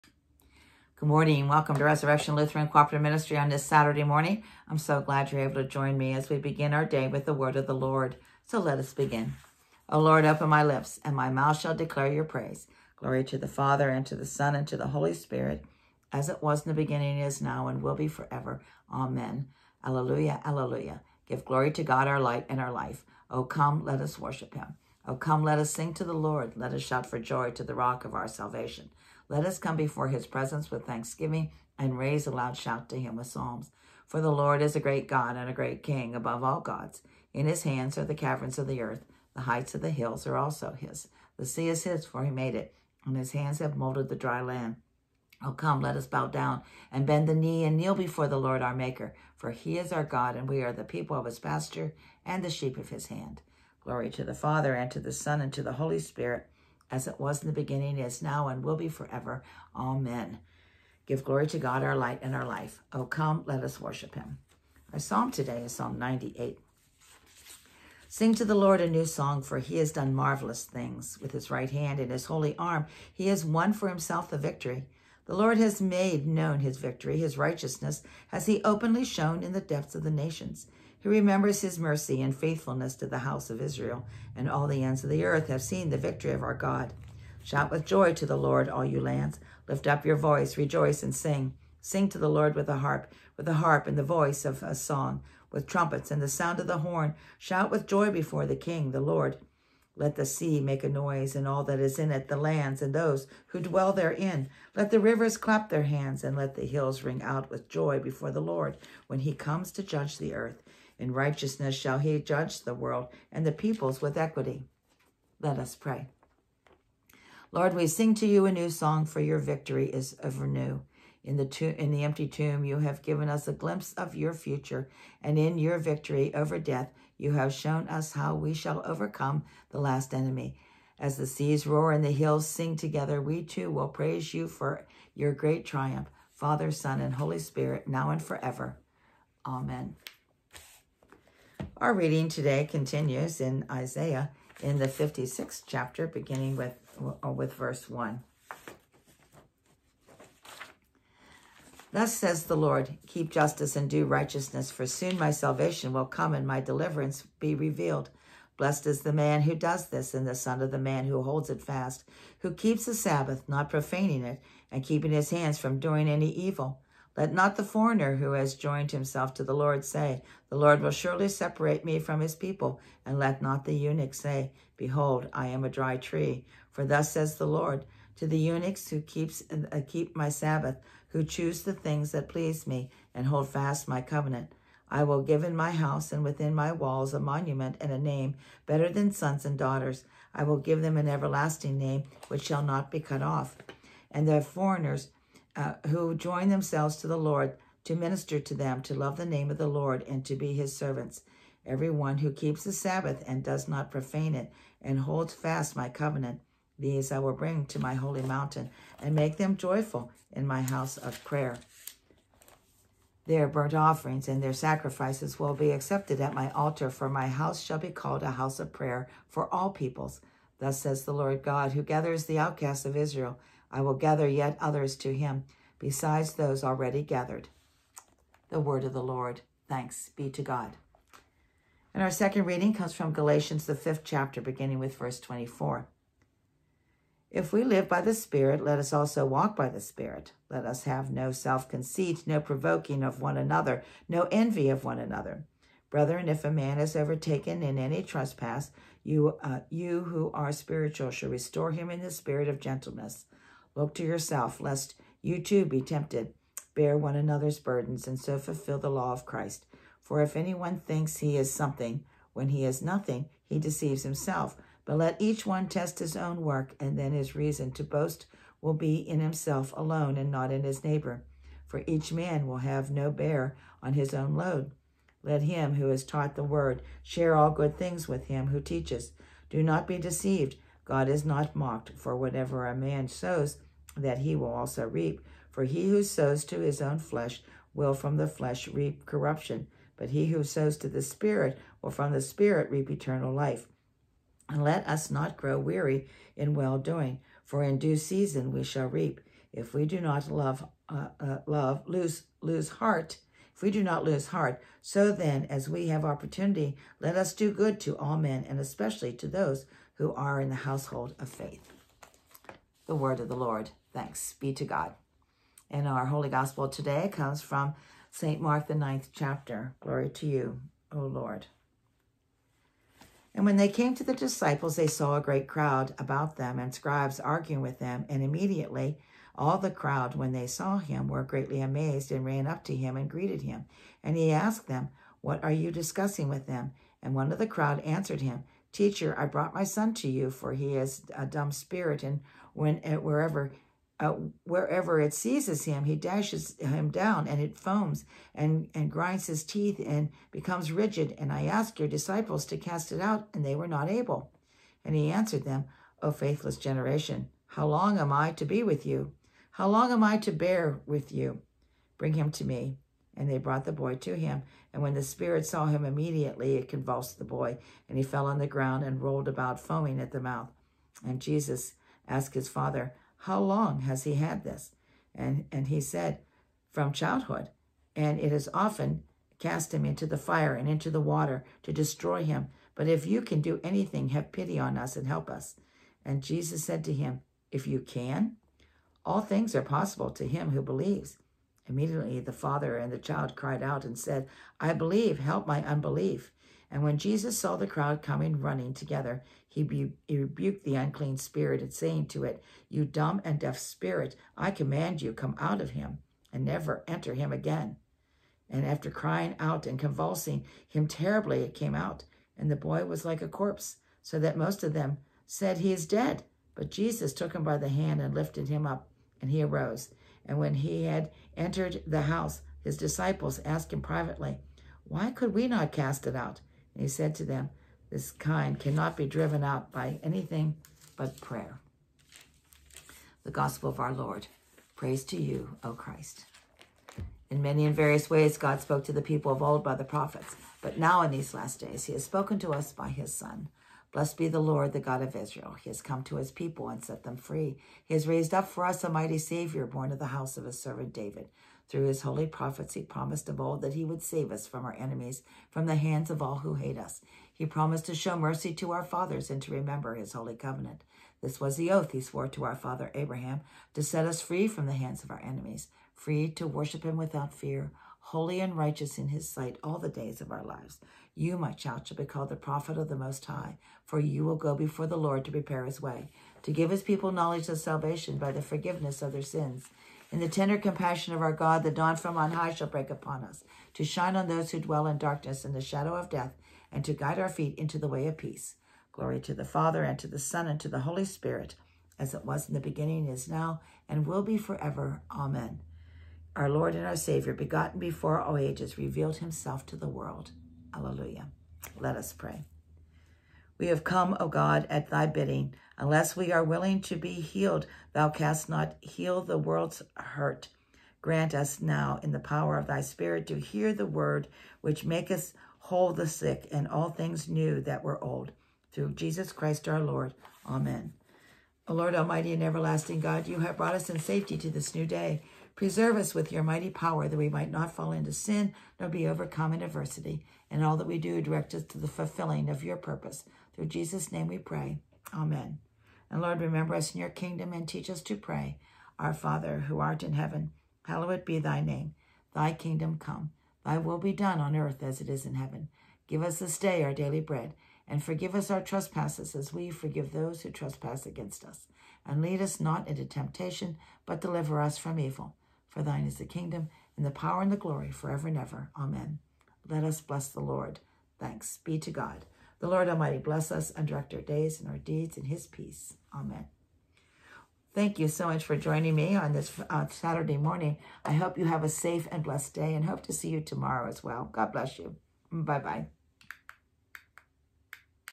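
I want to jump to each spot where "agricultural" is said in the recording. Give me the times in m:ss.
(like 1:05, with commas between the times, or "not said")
not said.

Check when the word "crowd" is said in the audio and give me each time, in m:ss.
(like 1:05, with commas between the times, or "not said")
5:25, 5:29, 5:37, 6:37.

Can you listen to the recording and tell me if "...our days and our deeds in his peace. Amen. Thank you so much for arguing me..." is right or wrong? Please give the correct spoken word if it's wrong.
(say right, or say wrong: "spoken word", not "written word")
wrong: "joining", not "arguing".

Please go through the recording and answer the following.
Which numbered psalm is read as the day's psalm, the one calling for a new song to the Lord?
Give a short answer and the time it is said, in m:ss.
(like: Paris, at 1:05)
Psalm 98, at 1:05.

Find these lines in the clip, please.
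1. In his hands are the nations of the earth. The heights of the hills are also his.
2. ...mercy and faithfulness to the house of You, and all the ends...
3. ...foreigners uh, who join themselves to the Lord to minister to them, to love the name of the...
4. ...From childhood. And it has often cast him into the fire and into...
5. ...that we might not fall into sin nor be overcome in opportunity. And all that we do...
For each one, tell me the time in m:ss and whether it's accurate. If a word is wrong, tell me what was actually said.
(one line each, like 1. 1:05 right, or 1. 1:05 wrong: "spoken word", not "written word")
1. 0:37 wrong: "caverns", not "nations"
2. 1:21 wrong: "Israel", not "You"
3. 3:14 right
4. 6:16 right
5. 8:47 wrong: "adversity", not "opportunity".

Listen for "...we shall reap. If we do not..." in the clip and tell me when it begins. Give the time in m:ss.
4:58.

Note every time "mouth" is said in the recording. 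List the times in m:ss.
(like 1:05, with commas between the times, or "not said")
0:11, 6:10.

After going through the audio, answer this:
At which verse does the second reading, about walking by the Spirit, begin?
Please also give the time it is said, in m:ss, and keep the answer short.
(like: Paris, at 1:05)
24, at 3:54.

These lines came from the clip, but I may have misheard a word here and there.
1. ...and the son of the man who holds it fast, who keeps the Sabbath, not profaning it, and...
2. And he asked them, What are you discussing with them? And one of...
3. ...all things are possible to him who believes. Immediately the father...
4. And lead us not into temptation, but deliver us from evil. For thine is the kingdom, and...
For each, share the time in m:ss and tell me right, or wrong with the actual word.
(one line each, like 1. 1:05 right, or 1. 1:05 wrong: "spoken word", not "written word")
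1. 2:40 right
2. 5:34 right
3. 6:29 right
4. 9:12 right.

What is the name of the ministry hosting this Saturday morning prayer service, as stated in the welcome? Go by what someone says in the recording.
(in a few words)
Resurrection Lutheran Cooperative Ministry.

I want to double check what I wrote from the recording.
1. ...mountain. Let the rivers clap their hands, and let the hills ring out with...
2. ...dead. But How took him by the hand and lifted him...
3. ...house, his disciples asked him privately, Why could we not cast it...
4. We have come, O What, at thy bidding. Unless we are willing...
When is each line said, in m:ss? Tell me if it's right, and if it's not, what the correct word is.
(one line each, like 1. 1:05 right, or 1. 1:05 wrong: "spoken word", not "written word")
1. 1:43 wrong: "therein", not "mountain"
2. 6:55 wrong: "Jesus", not "How"
3. 7:02 right
4. 8:23 wrong: "God", not "What".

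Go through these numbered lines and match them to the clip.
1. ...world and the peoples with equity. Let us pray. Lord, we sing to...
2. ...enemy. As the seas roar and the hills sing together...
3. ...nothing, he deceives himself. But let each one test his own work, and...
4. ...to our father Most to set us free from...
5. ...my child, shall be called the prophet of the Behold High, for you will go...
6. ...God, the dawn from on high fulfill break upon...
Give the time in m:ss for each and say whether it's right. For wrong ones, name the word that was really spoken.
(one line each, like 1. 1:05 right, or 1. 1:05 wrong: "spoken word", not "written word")
1. 1:52 right
2. 2:10 right
3. 4:22 right
4. 7:42 wrong: "Abraham", not "Most"
5. 7:51 wrong: "Most", not "Behold"
6. 8:01 wrong: "shall", not "fulfill".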